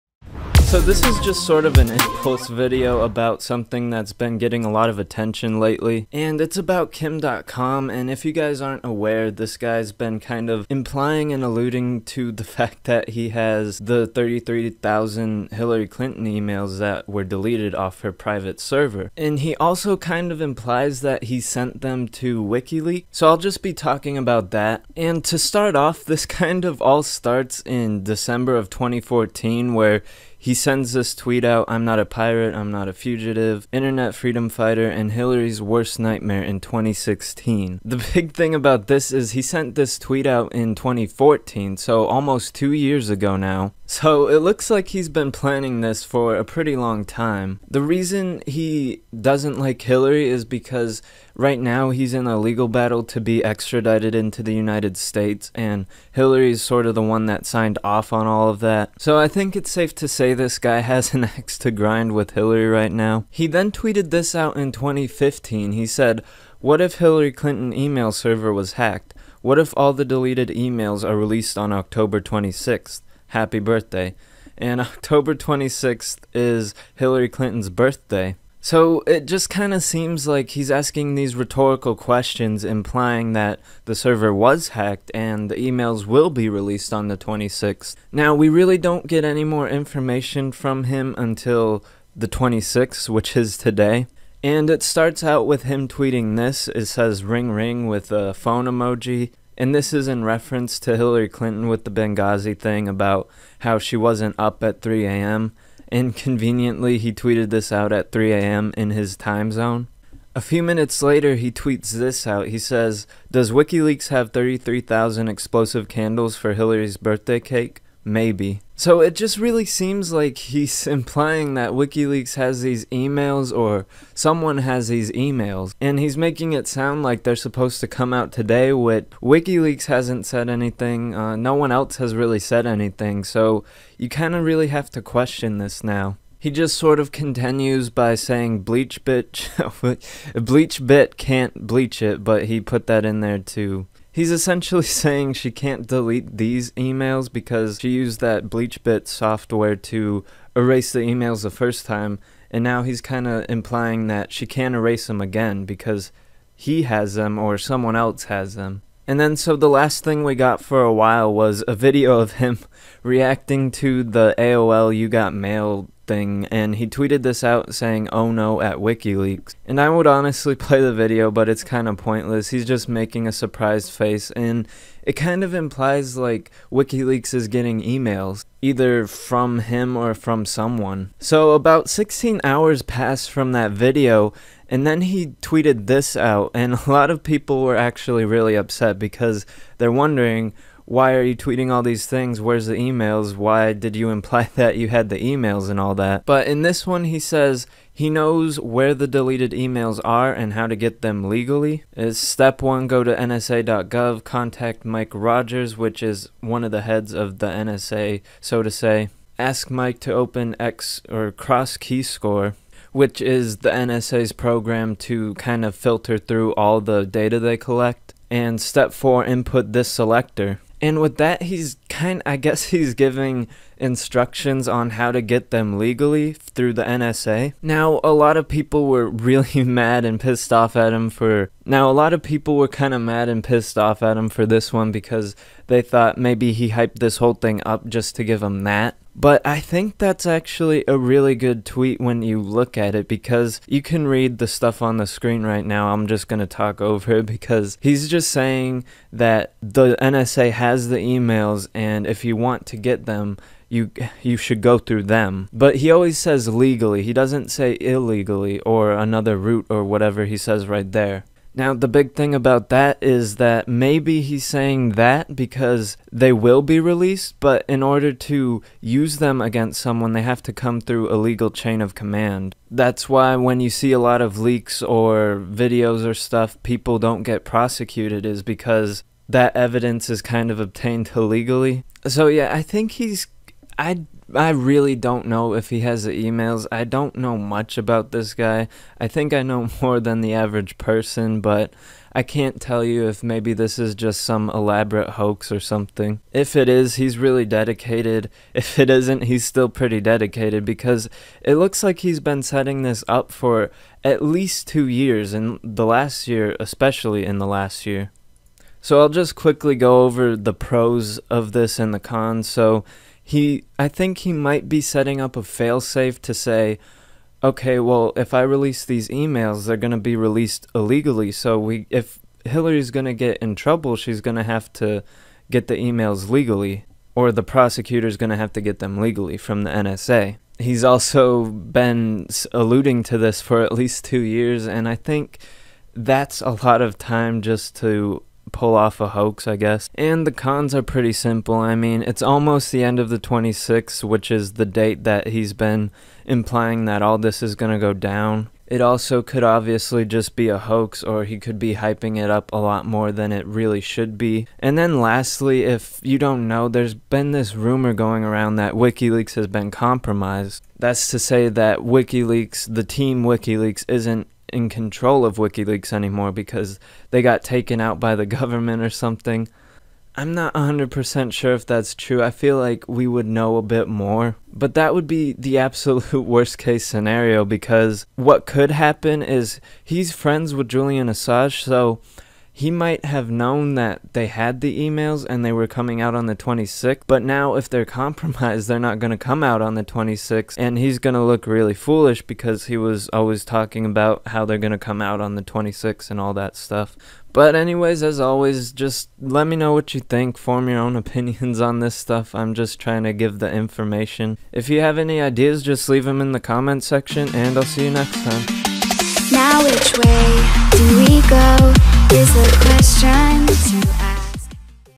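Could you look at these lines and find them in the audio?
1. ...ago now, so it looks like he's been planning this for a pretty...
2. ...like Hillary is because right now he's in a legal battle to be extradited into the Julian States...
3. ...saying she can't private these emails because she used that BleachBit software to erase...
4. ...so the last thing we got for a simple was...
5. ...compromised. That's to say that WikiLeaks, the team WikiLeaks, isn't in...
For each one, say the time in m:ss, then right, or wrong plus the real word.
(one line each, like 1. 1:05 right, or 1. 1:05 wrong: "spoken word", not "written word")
1. 0:43 right
2. 0:49 wrong: "United", not "Julian"
3. 2:24 wrong: "delete", not "private"
4. 2:39 wrong: "while", not "simple"
5. 5:59 right.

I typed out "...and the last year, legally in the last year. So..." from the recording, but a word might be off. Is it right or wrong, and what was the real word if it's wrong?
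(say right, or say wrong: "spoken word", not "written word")
wrong: "especially", not "legally".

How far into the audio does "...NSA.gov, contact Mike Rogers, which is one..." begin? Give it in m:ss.
3:23.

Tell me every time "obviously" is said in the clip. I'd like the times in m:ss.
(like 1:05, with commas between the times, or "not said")
5:49.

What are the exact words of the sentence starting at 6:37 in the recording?
But, anyways, as always, just let me know what you think.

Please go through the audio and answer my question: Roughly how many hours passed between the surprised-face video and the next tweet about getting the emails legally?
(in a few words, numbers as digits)
16.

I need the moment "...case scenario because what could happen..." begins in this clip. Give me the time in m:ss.
6:16.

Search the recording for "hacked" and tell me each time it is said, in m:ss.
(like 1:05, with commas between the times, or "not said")
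1:08, 1:24.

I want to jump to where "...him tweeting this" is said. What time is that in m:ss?
1:35.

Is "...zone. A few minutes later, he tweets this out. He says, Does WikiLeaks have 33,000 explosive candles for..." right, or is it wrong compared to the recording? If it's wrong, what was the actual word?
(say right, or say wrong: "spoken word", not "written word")
right.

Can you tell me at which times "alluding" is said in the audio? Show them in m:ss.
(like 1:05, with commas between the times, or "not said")
0:11, 5:32.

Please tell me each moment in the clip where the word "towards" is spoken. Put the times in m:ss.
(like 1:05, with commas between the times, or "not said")
not said.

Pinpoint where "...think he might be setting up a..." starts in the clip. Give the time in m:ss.
5:13.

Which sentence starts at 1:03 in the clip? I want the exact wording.
He then tweeted this out in 2015.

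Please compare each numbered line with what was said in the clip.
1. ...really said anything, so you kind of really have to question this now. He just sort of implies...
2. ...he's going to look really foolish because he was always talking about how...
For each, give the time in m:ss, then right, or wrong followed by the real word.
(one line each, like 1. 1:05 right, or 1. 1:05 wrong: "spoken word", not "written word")
1. 2:12 wrong: "continues", not "implies"
2. 6:30 right.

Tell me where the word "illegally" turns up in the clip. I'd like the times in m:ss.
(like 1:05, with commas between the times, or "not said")
4:17, 4:41, 5:20.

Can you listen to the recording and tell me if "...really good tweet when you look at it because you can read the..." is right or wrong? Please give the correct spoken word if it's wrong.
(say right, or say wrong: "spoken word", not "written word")
right.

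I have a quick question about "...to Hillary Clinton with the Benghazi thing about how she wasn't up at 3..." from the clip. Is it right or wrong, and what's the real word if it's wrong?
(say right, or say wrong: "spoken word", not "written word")
right.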